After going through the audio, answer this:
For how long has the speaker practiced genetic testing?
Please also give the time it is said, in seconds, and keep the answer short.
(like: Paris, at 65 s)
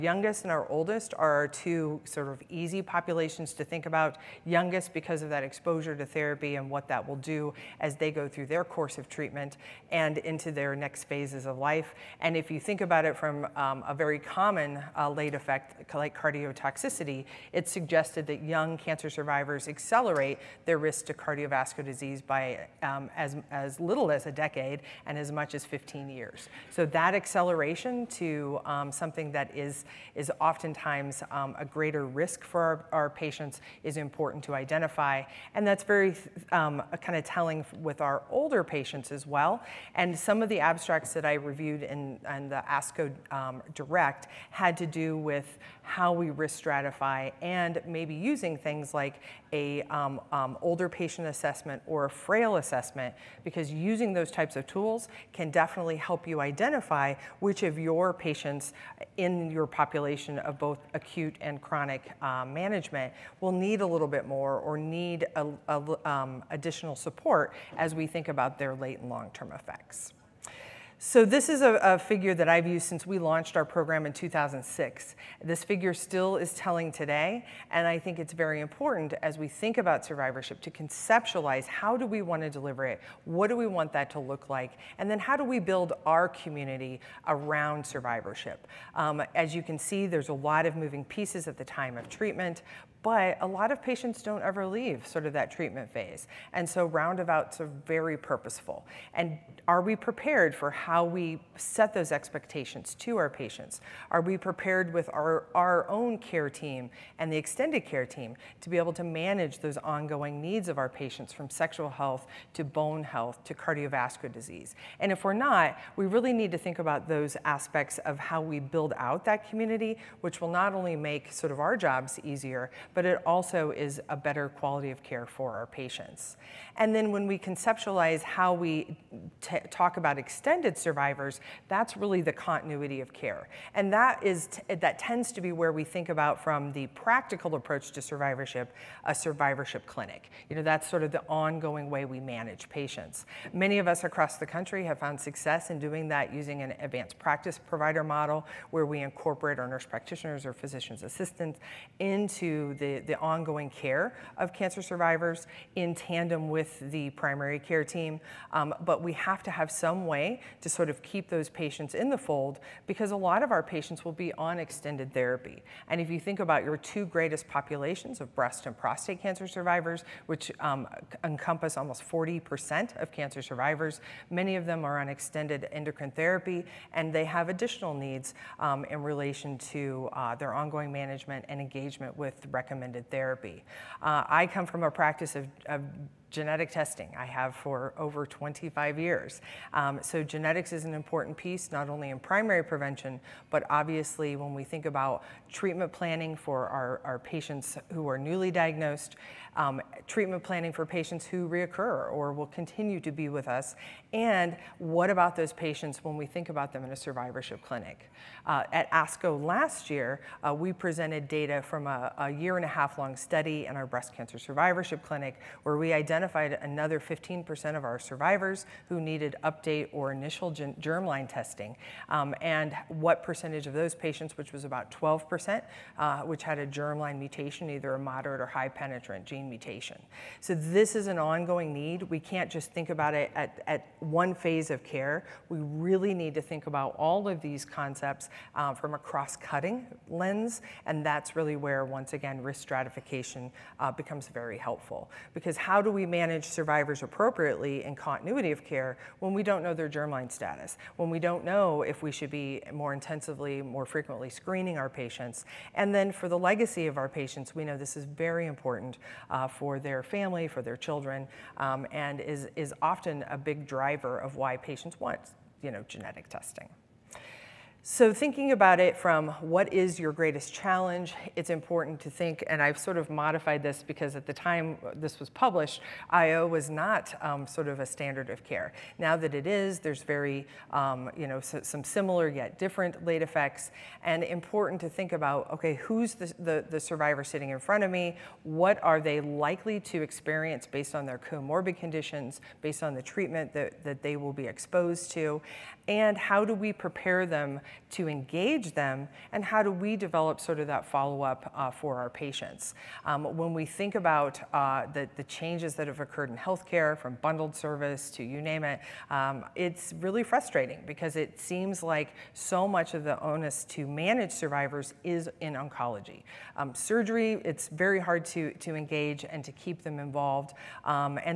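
over 25 years, at 187 s.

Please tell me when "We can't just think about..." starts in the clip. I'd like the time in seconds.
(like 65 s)
232 s.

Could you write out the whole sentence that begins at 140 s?
You know, that's sort of the ongoing way we manage patients.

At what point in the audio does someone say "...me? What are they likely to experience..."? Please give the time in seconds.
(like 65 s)
287 s.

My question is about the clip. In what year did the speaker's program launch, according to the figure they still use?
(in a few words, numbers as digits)
2006.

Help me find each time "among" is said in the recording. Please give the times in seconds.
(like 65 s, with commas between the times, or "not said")
not said.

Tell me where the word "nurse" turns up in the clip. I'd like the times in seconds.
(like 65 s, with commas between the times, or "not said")
149 s.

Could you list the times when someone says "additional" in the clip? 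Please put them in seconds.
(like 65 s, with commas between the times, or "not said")
66 s, 177 s.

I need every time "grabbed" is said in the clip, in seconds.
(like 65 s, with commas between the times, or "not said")
not said.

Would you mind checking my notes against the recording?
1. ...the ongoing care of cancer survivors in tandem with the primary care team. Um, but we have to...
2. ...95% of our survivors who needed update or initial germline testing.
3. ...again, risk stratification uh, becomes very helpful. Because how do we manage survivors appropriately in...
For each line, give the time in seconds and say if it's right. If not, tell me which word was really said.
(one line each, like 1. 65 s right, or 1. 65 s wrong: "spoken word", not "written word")
1. 153 s right
2. 216 s wrong: "15", not "95"
3. 242 s right.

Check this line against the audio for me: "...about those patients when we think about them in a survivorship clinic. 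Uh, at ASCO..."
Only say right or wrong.
right.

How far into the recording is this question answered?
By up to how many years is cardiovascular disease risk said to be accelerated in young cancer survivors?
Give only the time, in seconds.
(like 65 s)
25 s.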